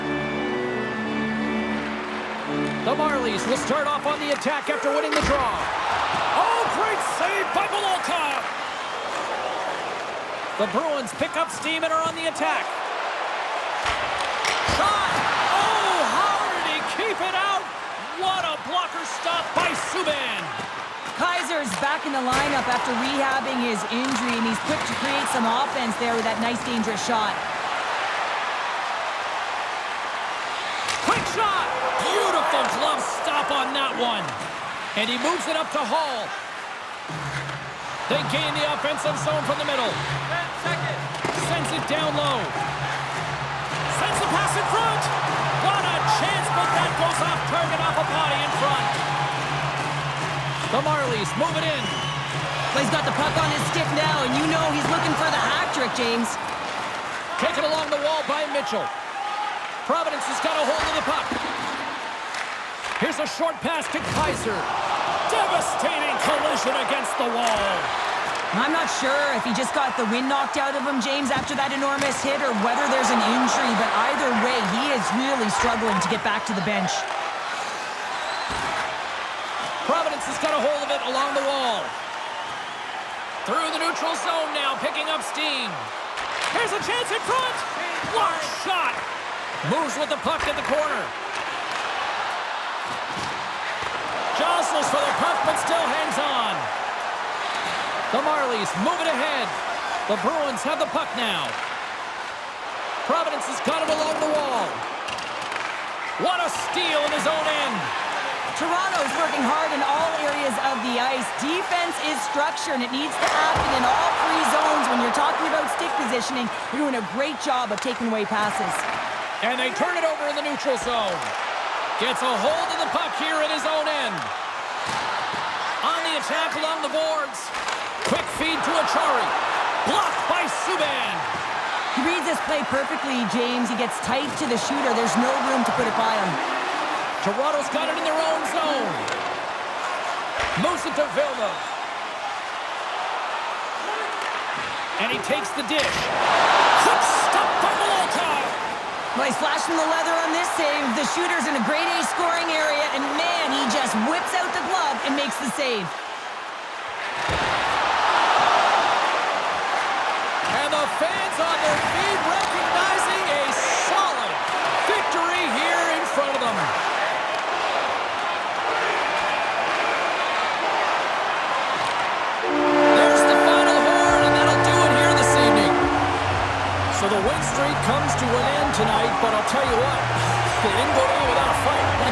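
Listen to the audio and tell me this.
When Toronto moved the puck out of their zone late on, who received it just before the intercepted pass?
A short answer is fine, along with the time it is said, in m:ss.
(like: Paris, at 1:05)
Vilma, at 2:21.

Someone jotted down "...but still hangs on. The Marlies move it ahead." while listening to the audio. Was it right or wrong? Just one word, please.
right.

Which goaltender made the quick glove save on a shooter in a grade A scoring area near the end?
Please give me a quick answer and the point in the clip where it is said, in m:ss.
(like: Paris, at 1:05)
Molotov, at 2:27.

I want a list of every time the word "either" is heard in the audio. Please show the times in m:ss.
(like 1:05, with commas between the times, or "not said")
1:14.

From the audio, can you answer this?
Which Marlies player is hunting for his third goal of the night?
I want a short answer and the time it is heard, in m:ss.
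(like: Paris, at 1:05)
Clay, at 0:52.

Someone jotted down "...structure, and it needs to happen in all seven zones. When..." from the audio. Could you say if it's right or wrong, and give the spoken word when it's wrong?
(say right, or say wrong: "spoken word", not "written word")
wrong: "three", not "seven".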